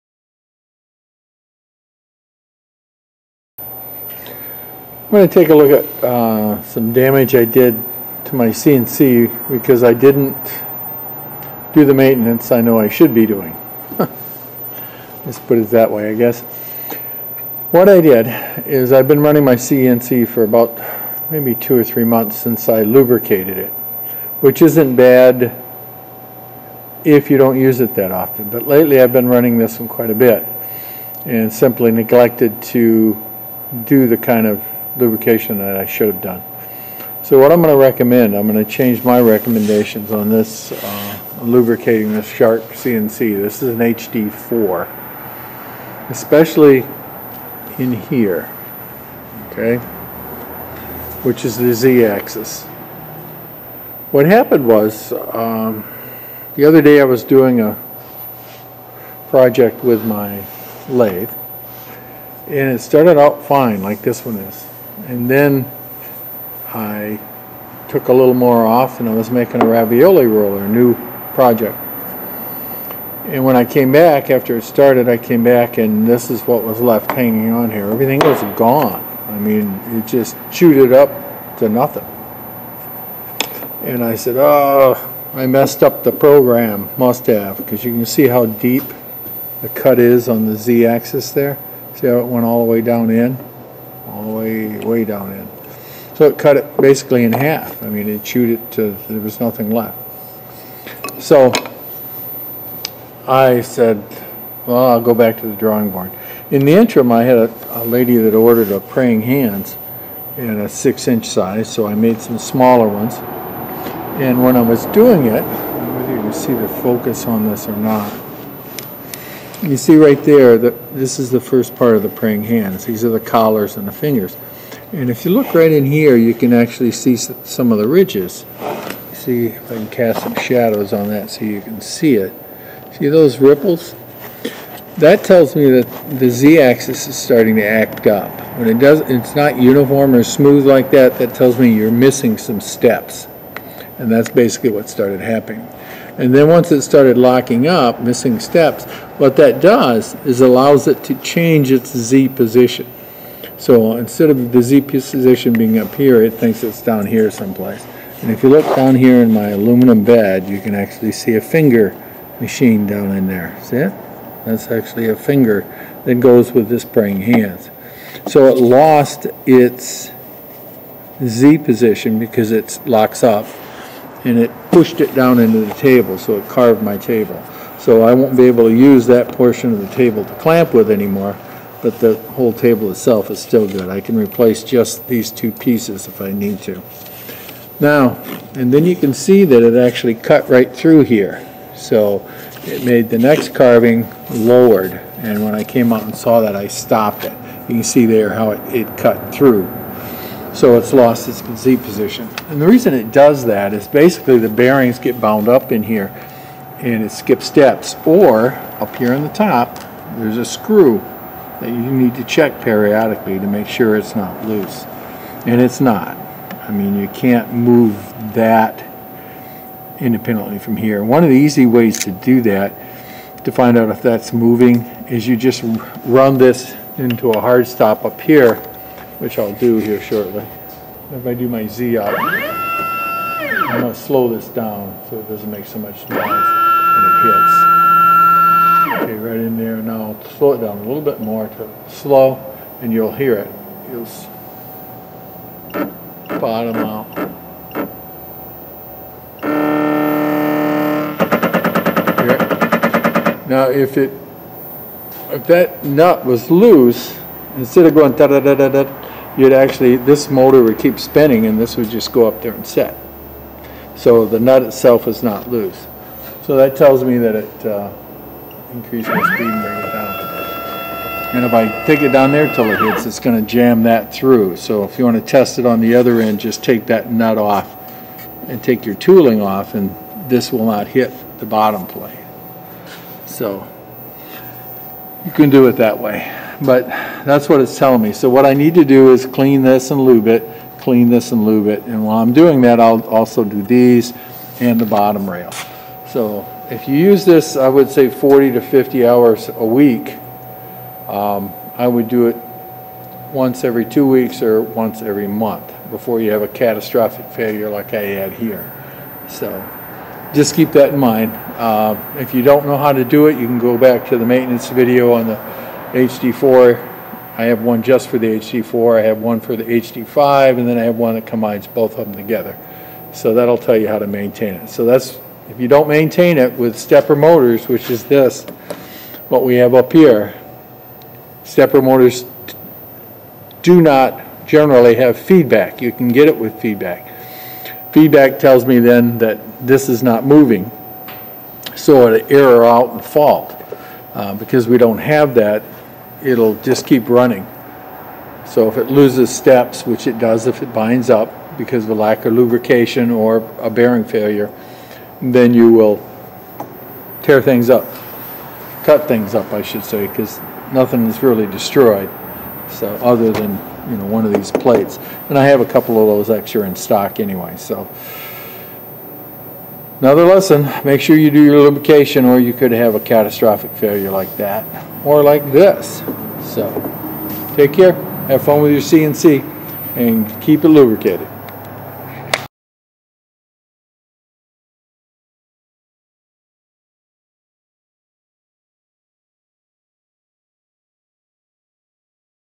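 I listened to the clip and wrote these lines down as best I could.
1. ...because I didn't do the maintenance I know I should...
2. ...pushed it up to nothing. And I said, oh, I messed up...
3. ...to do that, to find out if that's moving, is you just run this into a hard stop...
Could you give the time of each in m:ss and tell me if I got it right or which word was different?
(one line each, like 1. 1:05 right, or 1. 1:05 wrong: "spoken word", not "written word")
1. 0:09 right
2. 1:20 wrong: "chewed", not "pushed"
3. 3:42 right.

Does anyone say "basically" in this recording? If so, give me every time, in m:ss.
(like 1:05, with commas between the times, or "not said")
1:36, 2:24, 3:23.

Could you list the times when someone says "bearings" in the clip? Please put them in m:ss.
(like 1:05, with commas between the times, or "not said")
3:24, 5:53.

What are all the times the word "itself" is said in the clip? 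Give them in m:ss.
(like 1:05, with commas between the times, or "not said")
3:02, 4:24.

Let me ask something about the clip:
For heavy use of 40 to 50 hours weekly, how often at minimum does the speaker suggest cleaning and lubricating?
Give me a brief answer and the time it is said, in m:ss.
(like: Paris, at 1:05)
Once every two weeks, at 5:03.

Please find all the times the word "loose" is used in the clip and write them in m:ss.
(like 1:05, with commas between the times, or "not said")
3:34, 4:16, 4:25.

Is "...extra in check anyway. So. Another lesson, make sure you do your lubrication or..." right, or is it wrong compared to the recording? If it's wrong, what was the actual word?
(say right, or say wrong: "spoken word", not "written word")
wrong: "stock", not "check".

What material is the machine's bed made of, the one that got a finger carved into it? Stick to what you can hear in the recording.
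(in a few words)
Aluminum.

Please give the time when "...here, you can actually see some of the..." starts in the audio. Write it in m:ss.
2:05.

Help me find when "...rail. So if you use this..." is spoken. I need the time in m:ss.
4:55.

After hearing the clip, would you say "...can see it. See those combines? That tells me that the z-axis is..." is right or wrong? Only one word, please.
wrong.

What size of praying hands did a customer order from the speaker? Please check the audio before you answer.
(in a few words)
6 inch.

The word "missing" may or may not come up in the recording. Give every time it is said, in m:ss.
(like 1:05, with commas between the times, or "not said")
2:21, 2:28.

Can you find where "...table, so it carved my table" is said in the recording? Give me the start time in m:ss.
2:55.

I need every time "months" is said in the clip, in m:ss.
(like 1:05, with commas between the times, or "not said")
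0:22, 5:05.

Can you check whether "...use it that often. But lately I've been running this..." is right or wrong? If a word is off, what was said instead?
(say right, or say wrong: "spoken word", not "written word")
right.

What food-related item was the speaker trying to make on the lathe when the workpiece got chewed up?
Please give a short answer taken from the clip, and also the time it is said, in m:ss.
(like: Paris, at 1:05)
Ravioli roller, at 1:09.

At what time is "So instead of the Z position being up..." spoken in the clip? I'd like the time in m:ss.
2:33.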